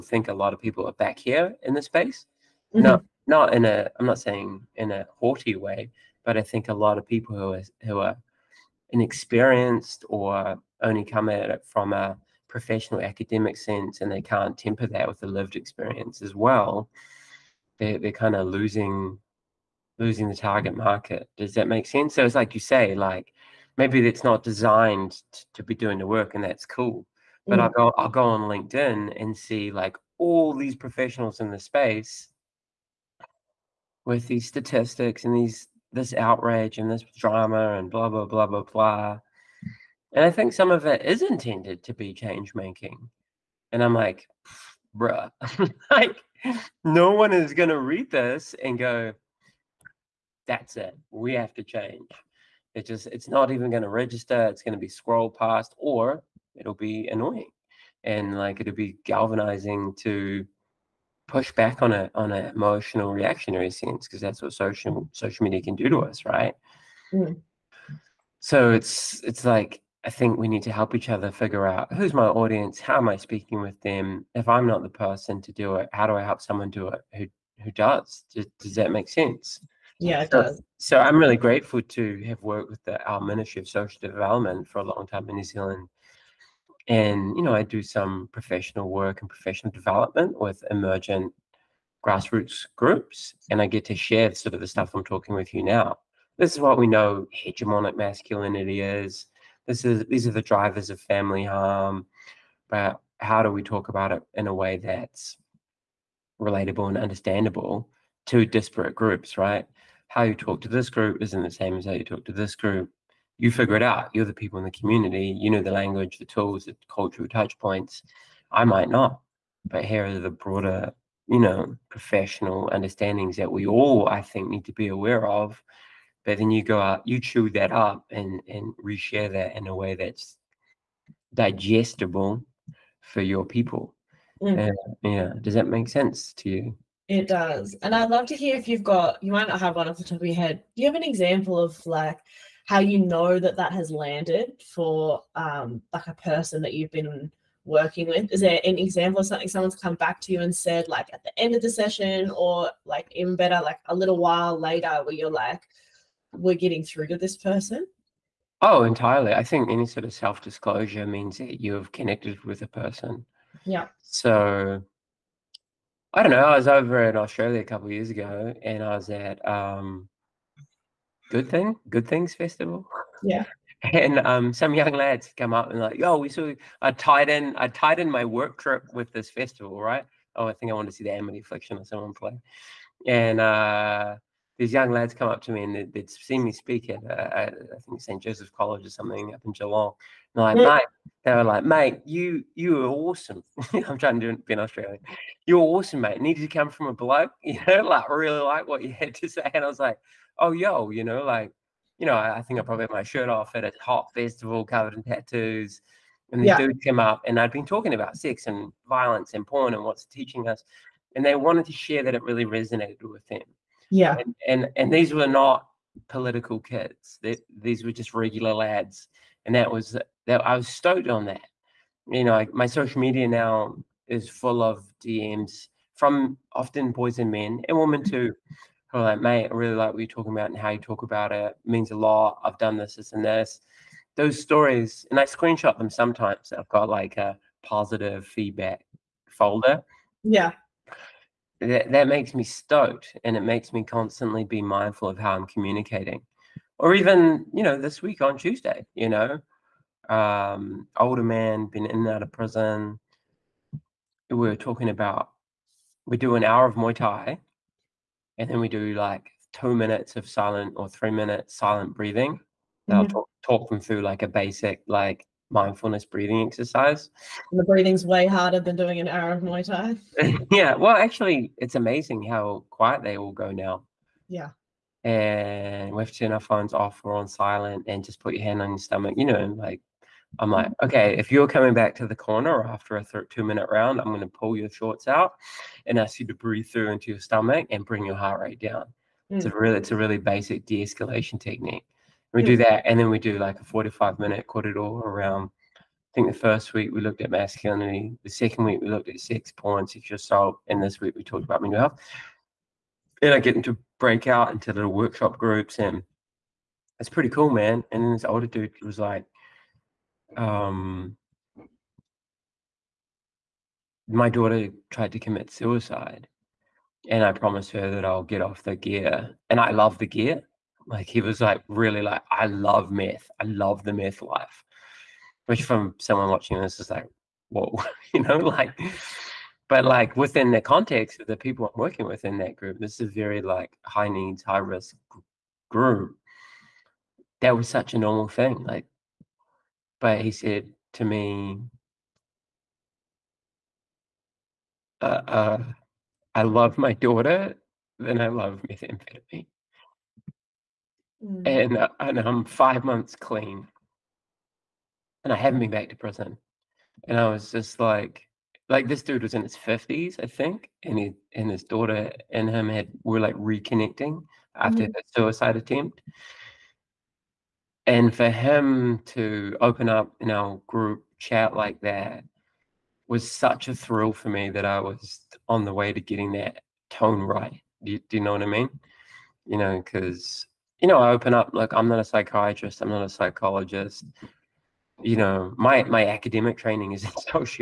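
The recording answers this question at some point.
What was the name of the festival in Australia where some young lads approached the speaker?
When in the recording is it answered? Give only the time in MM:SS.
02:51.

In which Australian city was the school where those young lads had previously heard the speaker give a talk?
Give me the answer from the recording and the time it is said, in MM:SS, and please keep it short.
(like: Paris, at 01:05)
Geelong, at 03:09.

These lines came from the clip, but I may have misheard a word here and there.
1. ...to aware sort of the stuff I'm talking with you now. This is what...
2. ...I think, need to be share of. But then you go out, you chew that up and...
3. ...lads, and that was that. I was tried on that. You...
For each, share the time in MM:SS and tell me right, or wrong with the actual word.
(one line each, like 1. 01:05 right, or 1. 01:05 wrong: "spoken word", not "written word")
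1. 01:33 wrong: "share", not "aware"
2. 02:04 wrong: "aware", not "share"
3. 03:38 wrong: "stoked", not "tried".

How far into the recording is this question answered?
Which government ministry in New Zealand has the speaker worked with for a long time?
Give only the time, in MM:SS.
01:23.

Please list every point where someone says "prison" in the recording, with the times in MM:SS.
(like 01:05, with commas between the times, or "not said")
04:12, 05:55.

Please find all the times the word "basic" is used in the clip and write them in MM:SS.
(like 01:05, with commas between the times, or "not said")
04:24, 04:50.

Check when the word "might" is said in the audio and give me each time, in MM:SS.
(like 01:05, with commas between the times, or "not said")
01:58, 02:19.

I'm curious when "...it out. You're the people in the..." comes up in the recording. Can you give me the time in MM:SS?
01:53.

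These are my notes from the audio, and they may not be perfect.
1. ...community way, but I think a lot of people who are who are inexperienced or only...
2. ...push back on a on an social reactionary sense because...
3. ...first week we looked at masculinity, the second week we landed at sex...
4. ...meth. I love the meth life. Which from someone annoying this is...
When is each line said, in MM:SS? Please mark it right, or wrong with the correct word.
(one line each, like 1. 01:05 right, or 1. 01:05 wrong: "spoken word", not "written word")
1. 00:05 wrong: "haughty", not "community"
2. 01:01 wrong: "emotional", not "social"
3. 04:56 wrong: "looked", not "landed"
4. 05:22 wrong: "watching", not "annoying".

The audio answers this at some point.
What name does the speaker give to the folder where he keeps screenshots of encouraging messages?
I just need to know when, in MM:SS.
03:57.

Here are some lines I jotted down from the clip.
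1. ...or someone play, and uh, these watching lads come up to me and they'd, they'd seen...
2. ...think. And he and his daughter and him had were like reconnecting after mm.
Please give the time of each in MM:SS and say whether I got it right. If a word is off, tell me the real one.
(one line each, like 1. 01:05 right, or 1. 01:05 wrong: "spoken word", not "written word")
1. 03:01 wrong: "young", not "watching"
2. 06:00 right.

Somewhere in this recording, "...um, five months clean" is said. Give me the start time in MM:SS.
05:52.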